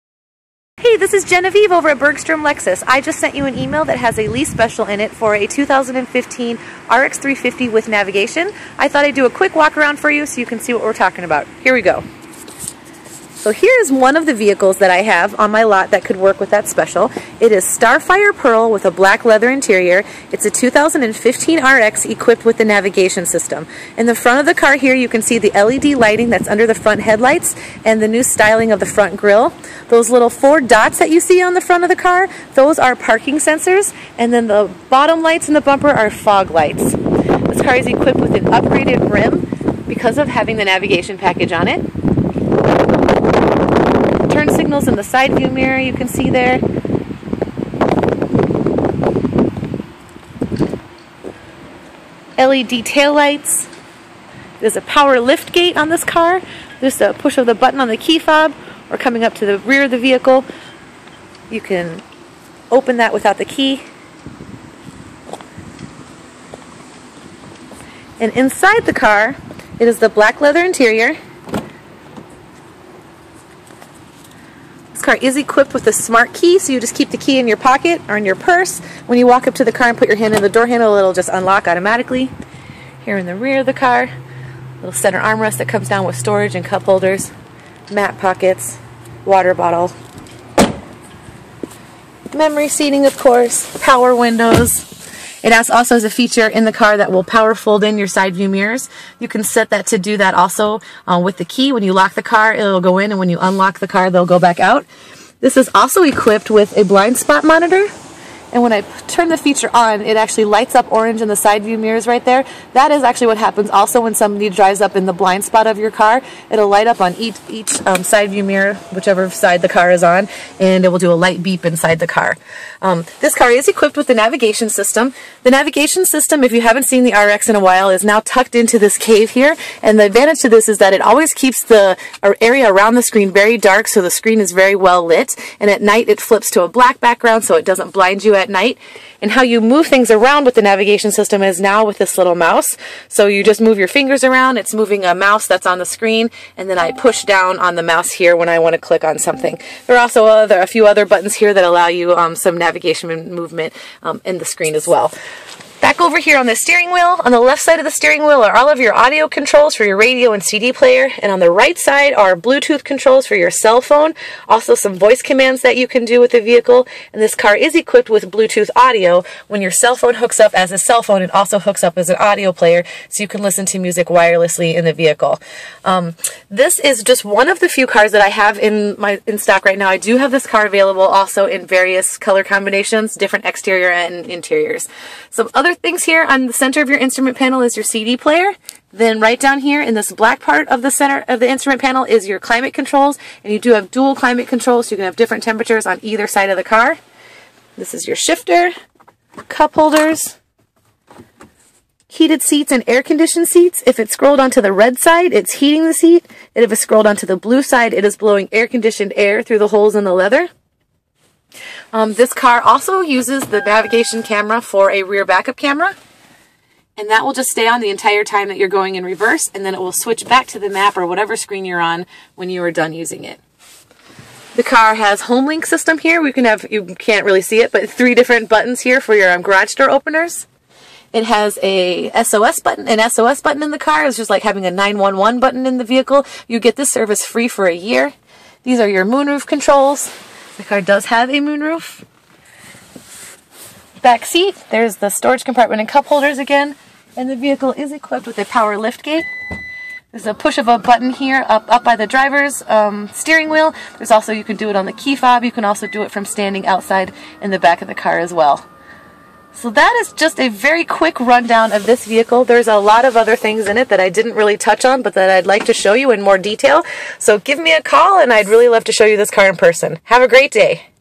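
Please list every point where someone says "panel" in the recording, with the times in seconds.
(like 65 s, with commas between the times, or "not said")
187 s, 191 s.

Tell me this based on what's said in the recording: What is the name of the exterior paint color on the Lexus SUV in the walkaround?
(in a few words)
Starfire Pearl.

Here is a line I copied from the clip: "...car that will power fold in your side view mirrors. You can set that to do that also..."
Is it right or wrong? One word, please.
right.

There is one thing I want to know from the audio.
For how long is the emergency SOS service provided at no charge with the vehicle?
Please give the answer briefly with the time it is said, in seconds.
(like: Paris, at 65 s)
1 year, at 237 s.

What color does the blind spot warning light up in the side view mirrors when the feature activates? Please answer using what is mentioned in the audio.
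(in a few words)
Orange.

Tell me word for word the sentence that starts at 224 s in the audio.
The car has home link system here.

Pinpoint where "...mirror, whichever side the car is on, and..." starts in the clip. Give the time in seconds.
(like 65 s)
118 s.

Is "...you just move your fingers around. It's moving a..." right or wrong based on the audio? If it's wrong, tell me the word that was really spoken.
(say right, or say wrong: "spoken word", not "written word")
right.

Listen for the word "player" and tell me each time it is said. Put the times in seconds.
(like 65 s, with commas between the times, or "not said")
160 s, 172 s, 188 s.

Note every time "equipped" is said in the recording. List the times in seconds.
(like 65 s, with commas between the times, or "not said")
22 s, 37 s, 75 s, 106 s, 123 s, 167 s, 247 s.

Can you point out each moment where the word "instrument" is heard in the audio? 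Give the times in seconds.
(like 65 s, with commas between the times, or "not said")
186 s, 191 s.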